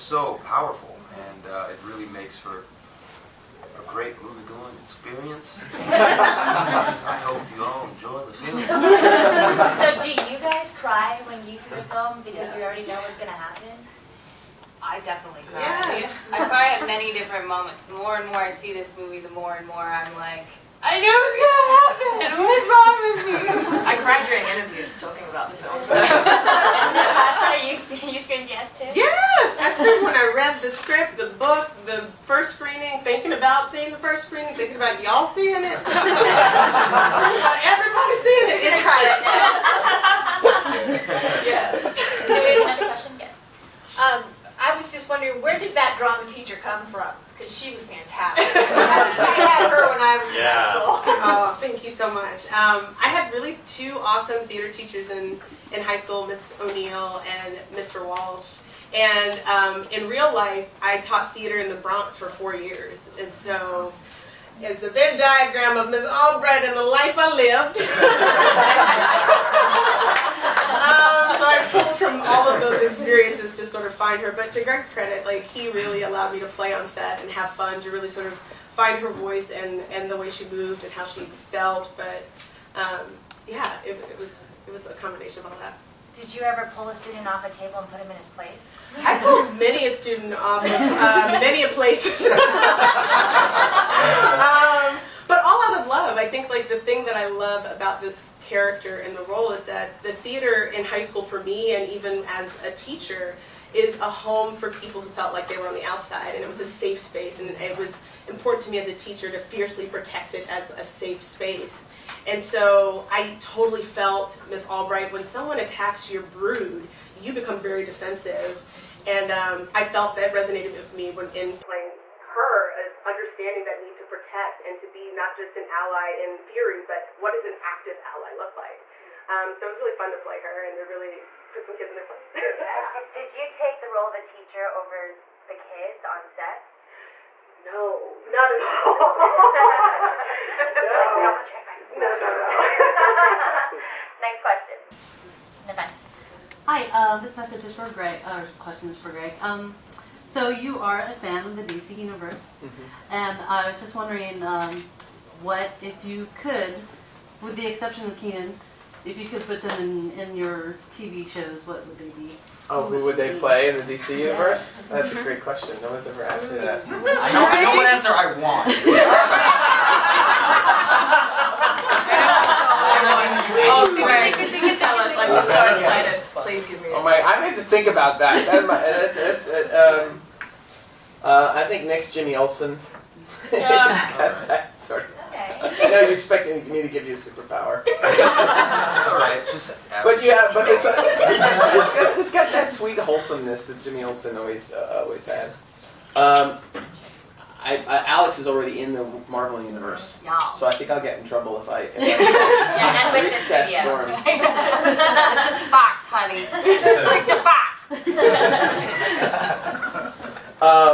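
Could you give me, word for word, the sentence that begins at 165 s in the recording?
No one's ever asked me that.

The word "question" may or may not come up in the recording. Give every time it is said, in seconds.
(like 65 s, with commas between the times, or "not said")
144 s, 148 s, 165 s.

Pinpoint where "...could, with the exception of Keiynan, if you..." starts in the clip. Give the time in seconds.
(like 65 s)
156 s.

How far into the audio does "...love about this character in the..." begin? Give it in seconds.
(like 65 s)
97 s.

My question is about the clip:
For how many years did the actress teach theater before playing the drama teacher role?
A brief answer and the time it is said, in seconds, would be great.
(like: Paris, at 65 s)
4, at 62 s.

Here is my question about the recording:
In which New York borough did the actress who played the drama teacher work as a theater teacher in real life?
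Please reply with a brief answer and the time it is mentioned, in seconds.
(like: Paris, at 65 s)
The Bronx, at 61 s.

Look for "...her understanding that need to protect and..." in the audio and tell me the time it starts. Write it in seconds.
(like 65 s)
122 s.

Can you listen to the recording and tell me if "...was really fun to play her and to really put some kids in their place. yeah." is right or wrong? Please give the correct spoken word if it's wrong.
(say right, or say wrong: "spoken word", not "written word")
right.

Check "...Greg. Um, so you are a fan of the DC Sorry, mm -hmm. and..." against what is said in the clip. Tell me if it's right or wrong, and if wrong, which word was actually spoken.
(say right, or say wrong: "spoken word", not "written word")
wrong: "Universe", not "Sorry".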